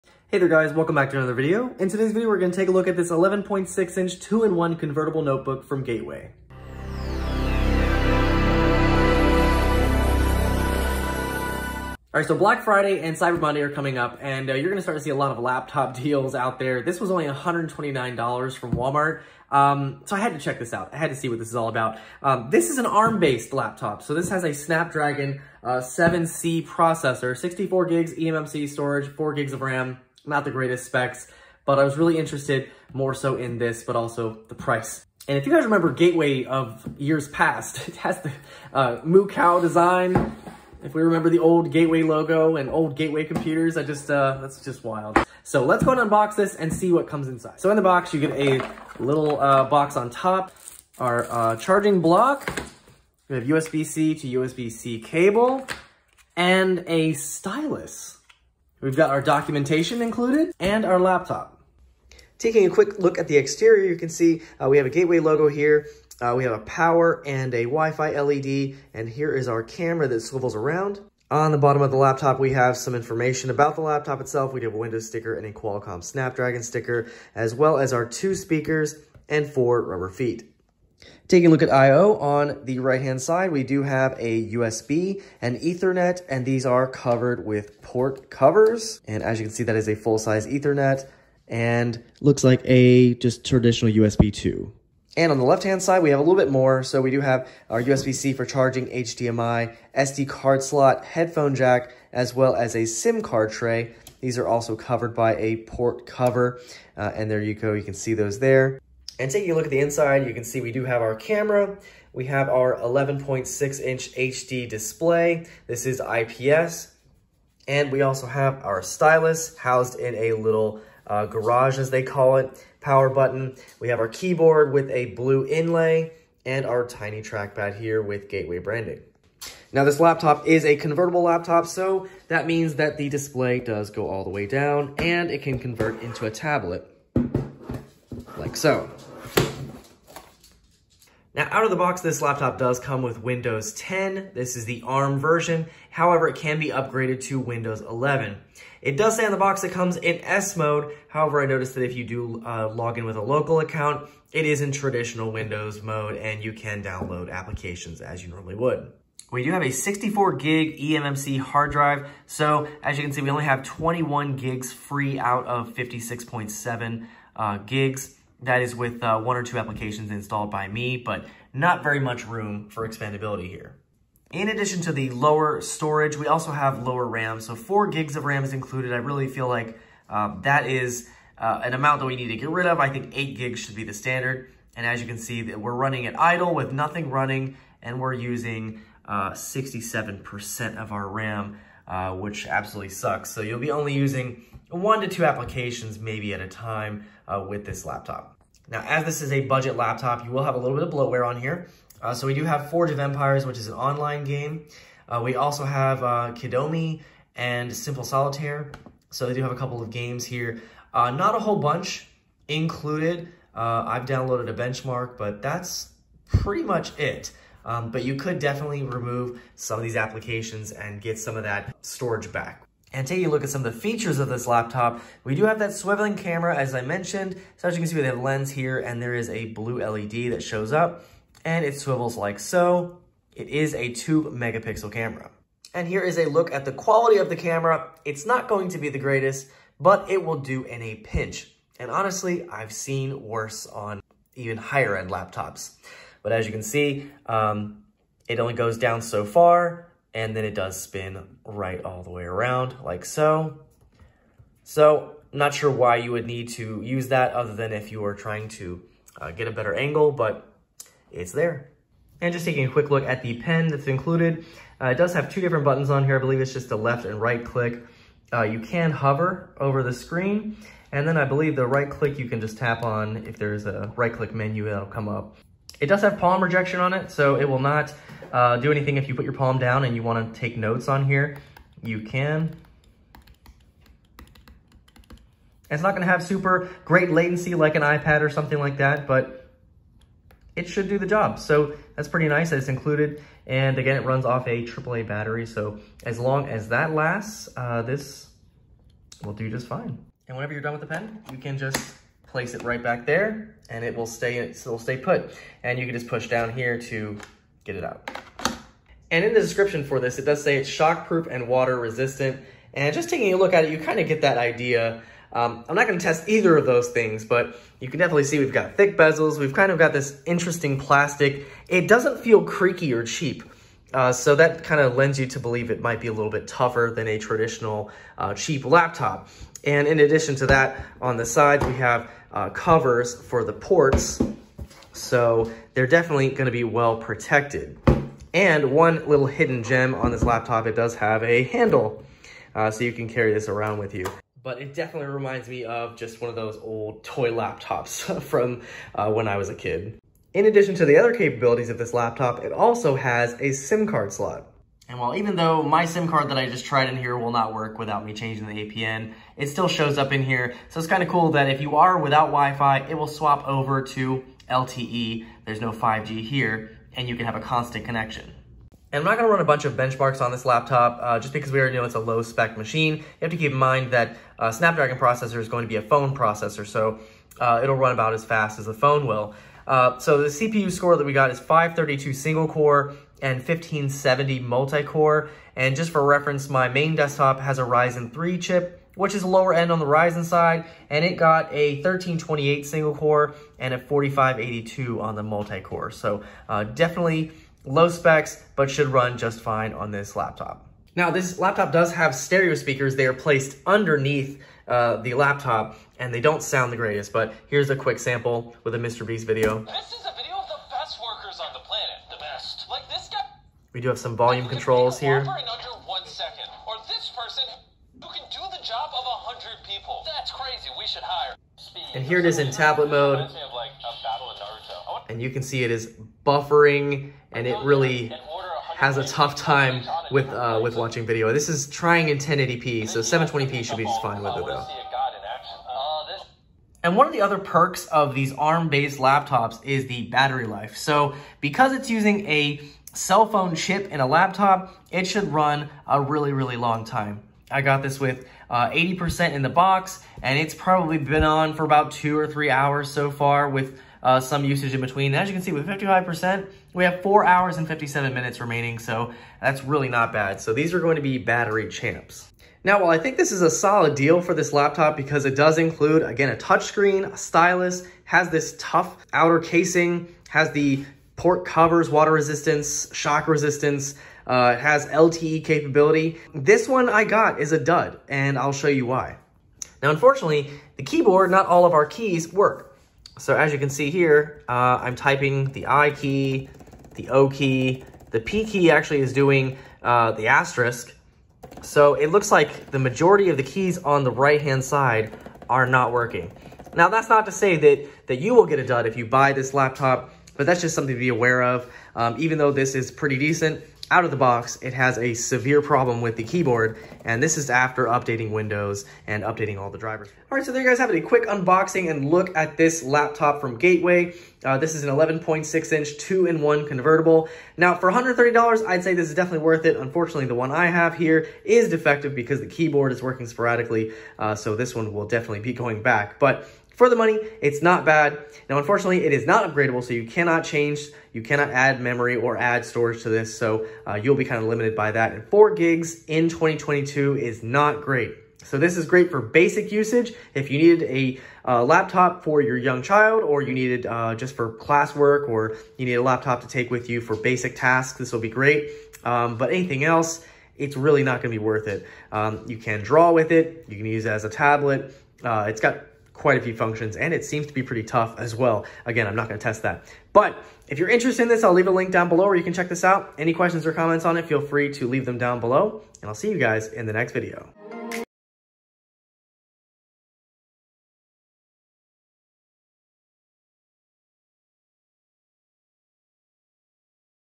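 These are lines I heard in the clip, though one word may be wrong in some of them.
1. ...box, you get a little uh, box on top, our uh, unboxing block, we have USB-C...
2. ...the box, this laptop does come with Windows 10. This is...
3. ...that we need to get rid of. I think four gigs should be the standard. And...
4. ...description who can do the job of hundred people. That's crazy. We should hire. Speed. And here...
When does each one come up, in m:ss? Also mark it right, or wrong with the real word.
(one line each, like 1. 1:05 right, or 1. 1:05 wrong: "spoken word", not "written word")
1. 0:47 wrong: "charging", not "unboxing"
2. 2:21 right
3. 3:01 wrong: "eight", not "four"
4. 6:57 wrong: "person", not "description".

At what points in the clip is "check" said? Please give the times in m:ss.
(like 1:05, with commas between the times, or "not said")
0:20, 9:22.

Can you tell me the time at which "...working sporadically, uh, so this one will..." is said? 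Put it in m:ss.
8:43.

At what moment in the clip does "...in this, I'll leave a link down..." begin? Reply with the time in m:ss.
9:21.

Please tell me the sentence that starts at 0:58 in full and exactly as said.
We've got our documentation included and our laptop.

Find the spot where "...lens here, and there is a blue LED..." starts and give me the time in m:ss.
3:48.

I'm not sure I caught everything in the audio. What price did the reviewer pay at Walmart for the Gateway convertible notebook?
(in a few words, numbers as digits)
$129.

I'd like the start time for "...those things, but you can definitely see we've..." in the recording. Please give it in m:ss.
5:16.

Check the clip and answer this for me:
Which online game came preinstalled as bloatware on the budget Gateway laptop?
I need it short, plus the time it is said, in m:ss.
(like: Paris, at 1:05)
Forge of Empires, at 3:22.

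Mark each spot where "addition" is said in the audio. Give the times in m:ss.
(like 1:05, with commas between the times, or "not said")
2:54, 5:29, 5:50.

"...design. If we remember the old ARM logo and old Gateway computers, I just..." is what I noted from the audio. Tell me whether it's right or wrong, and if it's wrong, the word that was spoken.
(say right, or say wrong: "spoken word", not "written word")
wrong: "Gateway", not "ARM".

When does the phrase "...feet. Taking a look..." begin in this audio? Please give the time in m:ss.
1:20.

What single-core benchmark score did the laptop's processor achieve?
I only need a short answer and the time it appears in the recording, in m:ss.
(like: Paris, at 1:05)
532, at 6:21.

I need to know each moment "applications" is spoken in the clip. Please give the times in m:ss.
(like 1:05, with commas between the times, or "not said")
2:37, 2:49, 3:15, 3:39.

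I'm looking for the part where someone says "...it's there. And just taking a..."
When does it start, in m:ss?
4:21.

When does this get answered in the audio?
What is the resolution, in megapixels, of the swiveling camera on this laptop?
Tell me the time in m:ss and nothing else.
3:53.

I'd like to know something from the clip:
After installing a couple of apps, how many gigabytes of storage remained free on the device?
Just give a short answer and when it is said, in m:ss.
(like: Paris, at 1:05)
21 gigs, at 2:43.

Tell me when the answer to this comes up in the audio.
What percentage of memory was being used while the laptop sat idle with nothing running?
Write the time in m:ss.
3:09.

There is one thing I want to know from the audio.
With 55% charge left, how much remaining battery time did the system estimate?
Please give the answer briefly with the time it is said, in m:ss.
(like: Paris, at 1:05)
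4 hours and 57 minutes, at 7:37.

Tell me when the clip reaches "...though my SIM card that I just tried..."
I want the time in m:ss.
5:55.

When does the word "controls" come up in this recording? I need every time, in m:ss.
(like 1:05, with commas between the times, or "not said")
6:54.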